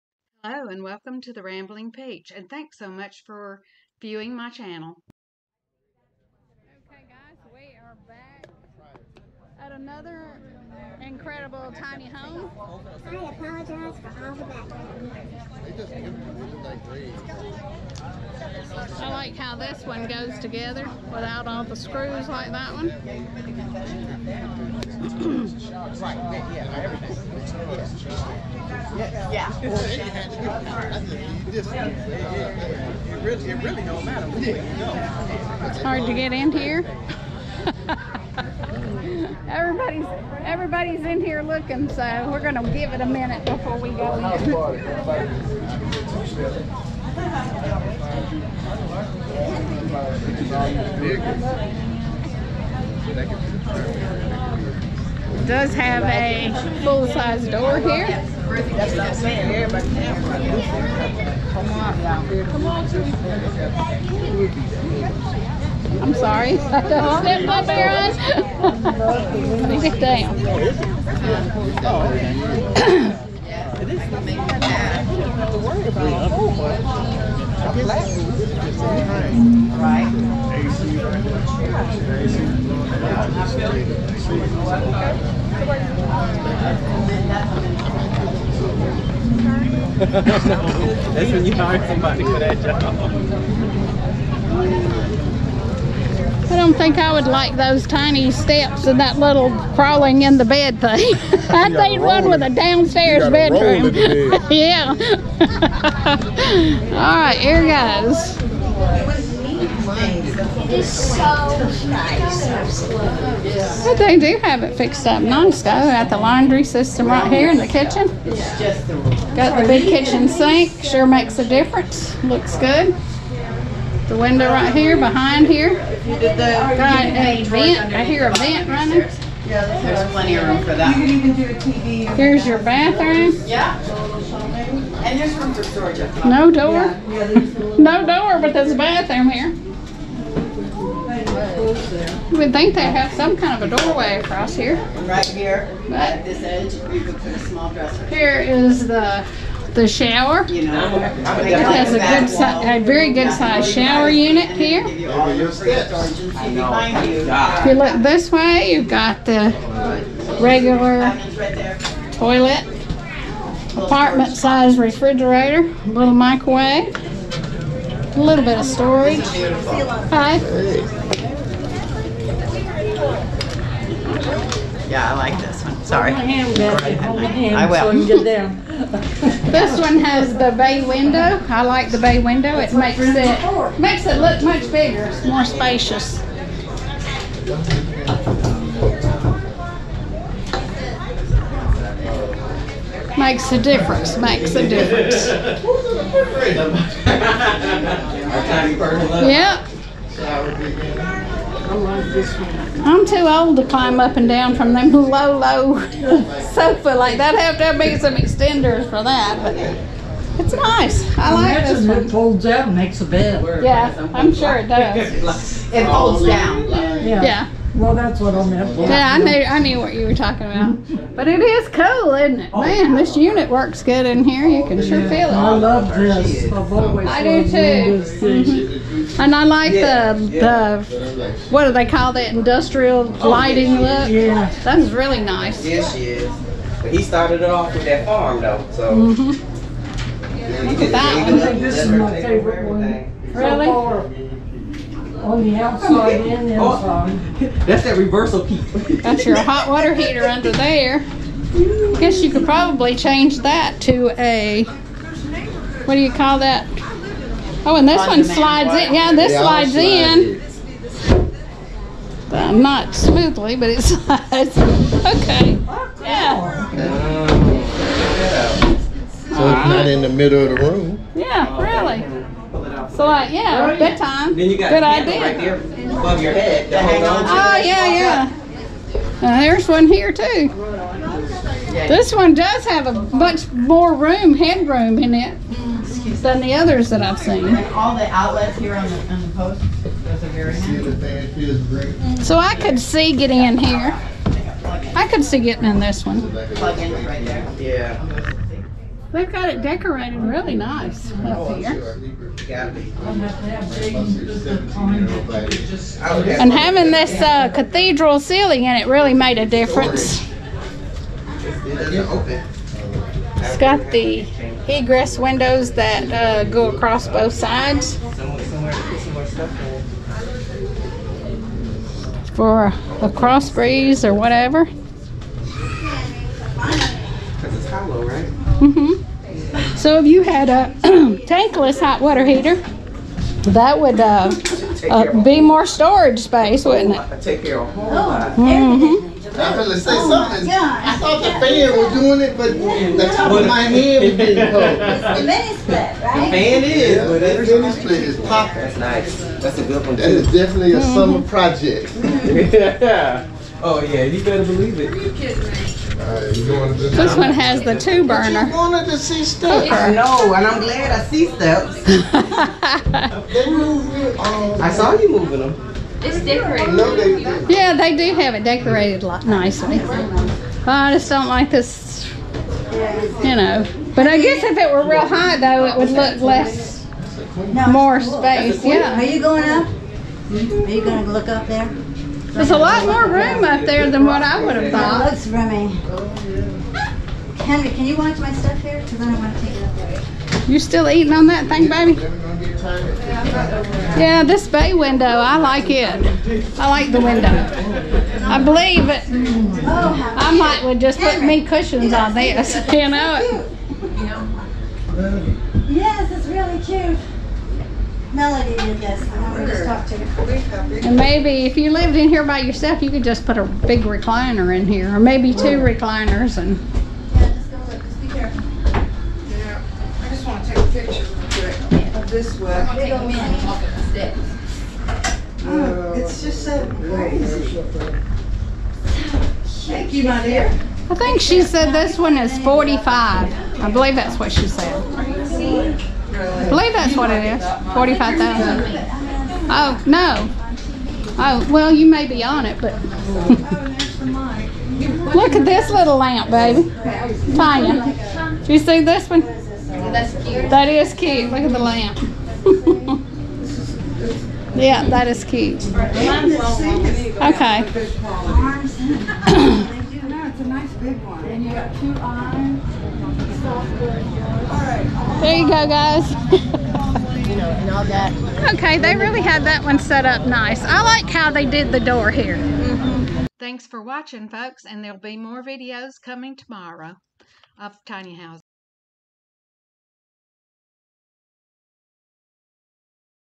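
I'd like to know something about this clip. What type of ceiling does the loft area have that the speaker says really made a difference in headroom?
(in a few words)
cathedral ceiling.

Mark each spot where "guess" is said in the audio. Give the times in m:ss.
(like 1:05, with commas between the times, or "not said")
4:11, 6:14.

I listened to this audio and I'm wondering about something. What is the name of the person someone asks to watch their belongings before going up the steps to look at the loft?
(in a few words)
Henry.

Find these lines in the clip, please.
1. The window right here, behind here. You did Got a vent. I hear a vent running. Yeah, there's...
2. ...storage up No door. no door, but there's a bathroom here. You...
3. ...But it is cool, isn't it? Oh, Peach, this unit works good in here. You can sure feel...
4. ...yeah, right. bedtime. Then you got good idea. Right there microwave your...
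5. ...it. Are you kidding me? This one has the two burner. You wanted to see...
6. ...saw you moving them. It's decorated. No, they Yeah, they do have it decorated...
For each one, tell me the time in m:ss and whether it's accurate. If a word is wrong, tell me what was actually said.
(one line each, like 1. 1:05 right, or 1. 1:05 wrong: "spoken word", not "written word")
1. 2:04 right
2. 2:15 right
3. 3:41 wrong: "Man", not "Peach"
4. 4:33 wrong: "above", not "microwave"
5. 5:54 right
6. 6:04 right.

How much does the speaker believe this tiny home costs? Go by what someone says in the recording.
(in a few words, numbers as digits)
$45,000.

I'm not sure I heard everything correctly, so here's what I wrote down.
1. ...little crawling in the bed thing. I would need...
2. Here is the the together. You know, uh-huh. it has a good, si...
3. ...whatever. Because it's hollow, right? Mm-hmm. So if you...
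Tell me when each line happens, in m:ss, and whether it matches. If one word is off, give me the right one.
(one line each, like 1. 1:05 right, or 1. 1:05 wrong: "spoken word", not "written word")
1. 1:39 right
2. 2:28 wrong: "shower", not "together"
3. 5:24 right.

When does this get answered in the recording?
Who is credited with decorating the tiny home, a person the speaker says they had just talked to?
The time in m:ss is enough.
6:48.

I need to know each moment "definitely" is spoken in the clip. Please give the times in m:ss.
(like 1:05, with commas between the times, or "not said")
5:50.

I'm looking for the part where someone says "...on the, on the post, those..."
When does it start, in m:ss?
4:48.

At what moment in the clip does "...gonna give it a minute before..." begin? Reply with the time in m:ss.
0:42.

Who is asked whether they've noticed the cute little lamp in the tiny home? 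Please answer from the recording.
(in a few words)
Tanya.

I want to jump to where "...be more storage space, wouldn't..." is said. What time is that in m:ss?
5:35.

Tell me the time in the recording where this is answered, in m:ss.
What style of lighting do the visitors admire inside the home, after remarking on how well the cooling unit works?
3:52.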